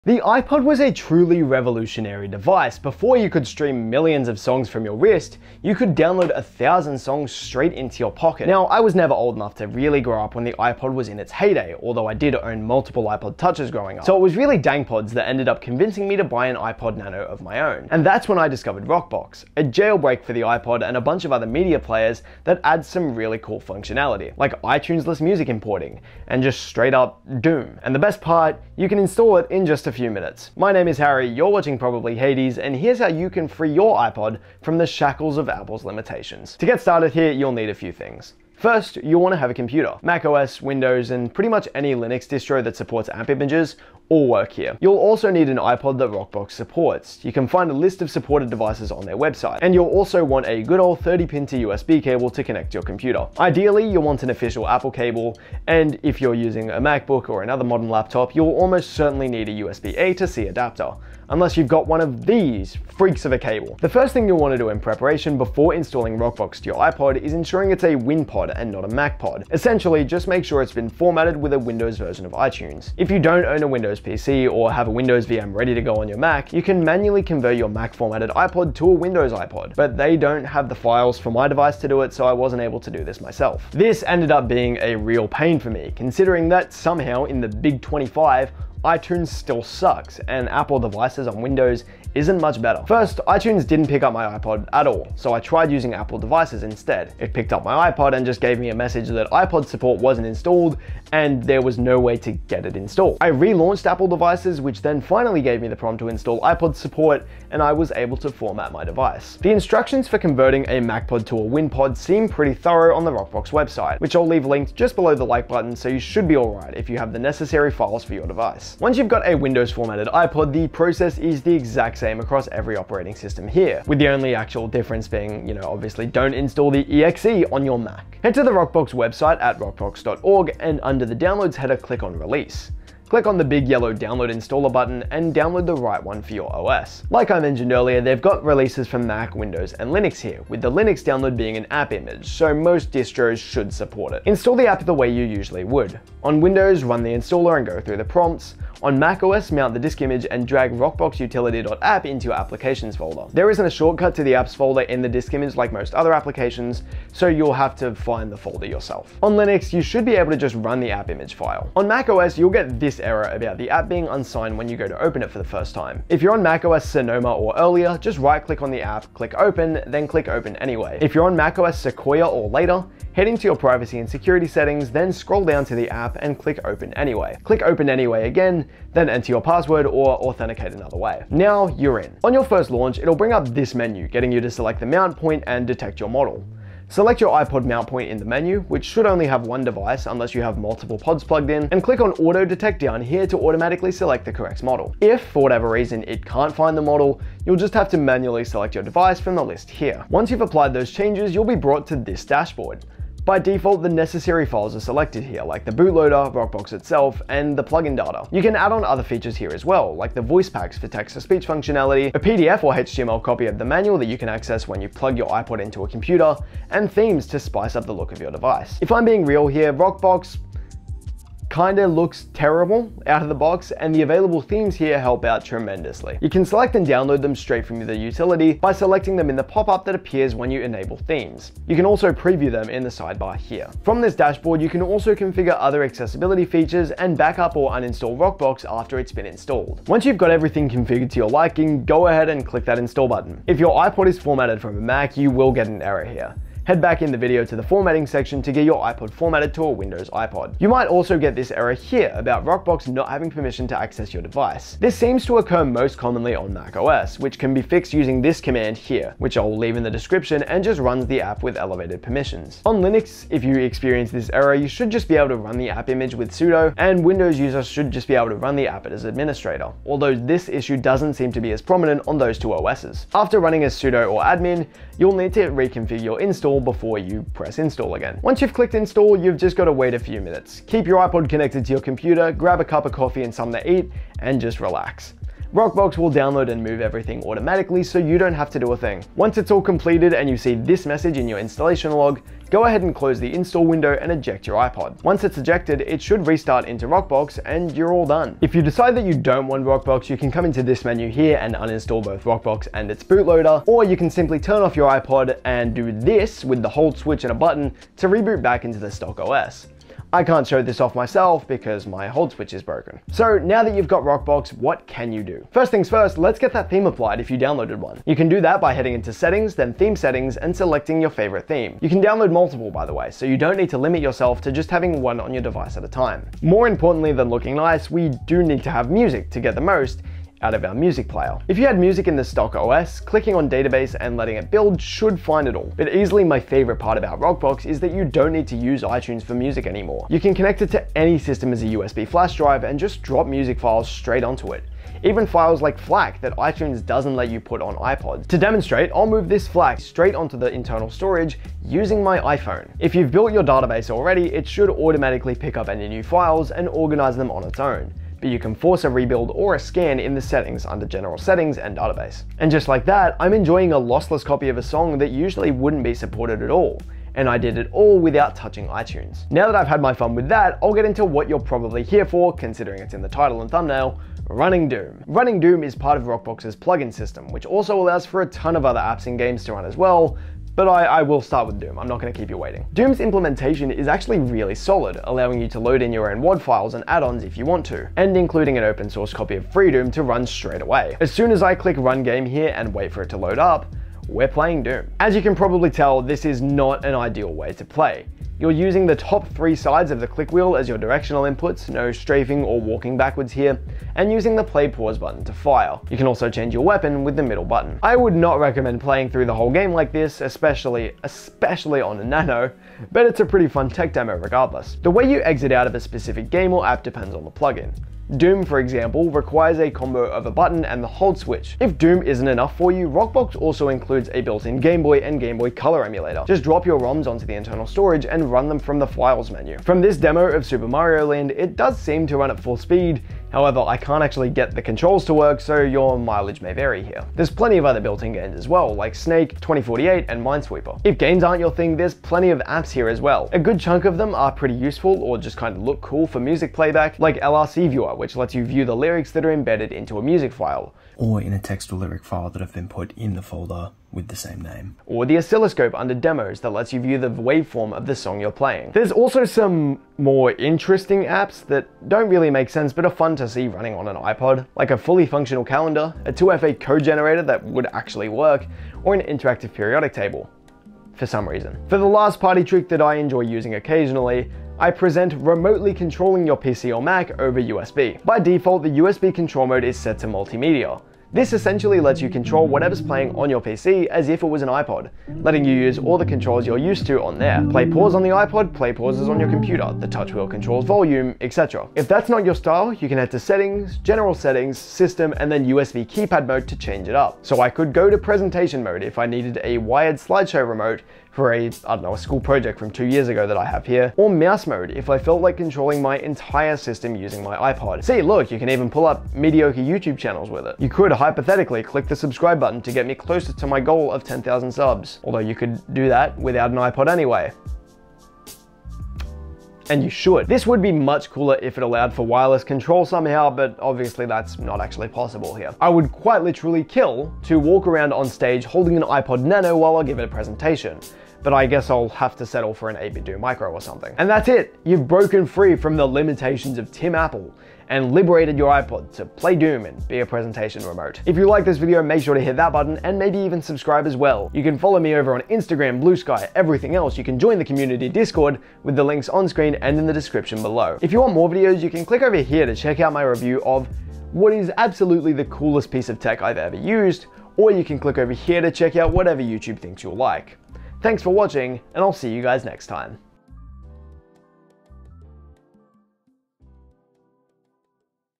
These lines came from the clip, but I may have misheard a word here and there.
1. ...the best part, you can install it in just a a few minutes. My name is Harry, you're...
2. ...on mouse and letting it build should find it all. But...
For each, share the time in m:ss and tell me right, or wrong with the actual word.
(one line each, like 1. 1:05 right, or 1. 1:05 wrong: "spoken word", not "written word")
1. 0:27 right
2. 5:33 wrong: "database", not "mouse".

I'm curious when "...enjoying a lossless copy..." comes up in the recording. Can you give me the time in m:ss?
6:03.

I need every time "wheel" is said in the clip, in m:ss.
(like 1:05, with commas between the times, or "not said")
6:40, 8:10.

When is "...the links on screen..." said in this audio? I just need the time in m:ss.
9:08.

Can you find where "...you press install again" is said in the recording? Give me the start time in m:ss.
4:36.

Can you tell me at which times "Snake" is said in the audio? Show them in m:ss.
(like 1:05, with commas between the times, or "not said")
7:18.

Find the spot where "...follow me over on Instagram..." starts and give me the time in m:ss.
9:04.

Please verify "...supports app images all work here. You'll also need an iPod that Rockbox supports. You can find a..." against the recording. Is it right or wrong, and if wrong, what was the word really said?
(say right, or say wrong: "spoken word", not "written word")
right.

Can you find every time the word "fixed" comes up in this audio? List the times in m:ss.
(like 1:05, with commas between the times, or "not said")
4:17.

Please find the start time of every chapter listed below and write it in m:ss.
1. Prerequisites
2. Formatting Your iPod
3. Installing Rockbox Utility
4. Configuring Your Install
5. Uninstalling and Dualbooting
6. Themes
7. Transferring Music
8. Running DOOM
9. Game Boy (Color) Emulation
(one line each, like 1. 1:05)
1. 0:36
2. 1:03
3. 1:58
4. 3:02
5. 4:58
6. 5:13
7. 5:26
8. 6:09
9. 7:01.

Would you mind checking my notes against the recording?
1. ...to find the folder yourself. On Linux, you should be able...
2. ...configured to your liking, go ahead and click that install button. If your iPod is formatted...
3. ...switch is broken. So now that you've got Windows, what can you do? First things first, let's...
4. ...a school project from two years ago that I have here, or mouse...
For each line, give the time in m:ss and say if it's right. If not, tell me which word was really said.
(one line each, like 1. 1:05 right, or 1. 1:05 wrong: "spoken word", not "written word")
1. 2:37 right
2. 4:00 right
3. 5:12 wrong: "Rockbox", not "Windows"
4. 8:21 right.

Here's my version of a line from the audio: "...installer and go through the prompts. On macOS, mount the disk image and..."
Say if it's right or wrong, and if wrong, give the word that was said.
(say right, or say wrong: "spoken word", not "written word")
right.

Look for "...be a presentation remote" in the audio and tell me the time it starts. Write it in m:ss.
8:59.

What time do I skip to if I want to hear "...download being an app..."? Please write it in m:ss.
2:21.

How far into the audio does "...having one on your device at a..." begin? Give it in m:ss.
5:24.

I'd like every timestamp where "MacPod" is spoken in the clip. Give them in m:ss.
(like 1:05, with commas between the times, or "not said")
1:08, 1:50.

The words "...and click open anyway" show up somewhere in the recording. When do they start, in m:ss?
2:56.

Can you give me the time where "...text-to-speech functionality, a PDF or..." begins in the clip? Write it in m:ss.
3:30.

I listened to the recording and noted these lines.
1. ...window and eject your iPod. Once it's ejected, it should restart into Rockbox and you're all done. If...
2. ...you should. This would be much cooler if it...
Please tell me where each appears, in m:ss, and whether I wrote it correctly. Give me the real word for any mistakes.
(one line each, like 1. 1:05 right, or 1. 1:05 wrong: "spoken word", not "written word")
1. 4:53 right
2. 8:39 right.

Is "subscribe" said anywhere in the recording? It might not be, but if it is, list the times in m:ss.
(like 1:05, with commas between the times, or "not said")
8:31, 9:03.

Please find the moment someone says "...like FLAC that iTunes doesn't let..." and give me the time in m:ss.
5:45.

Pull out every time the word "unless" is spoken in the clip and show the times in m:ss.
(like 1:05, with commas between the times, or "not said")
1:01, 3:10.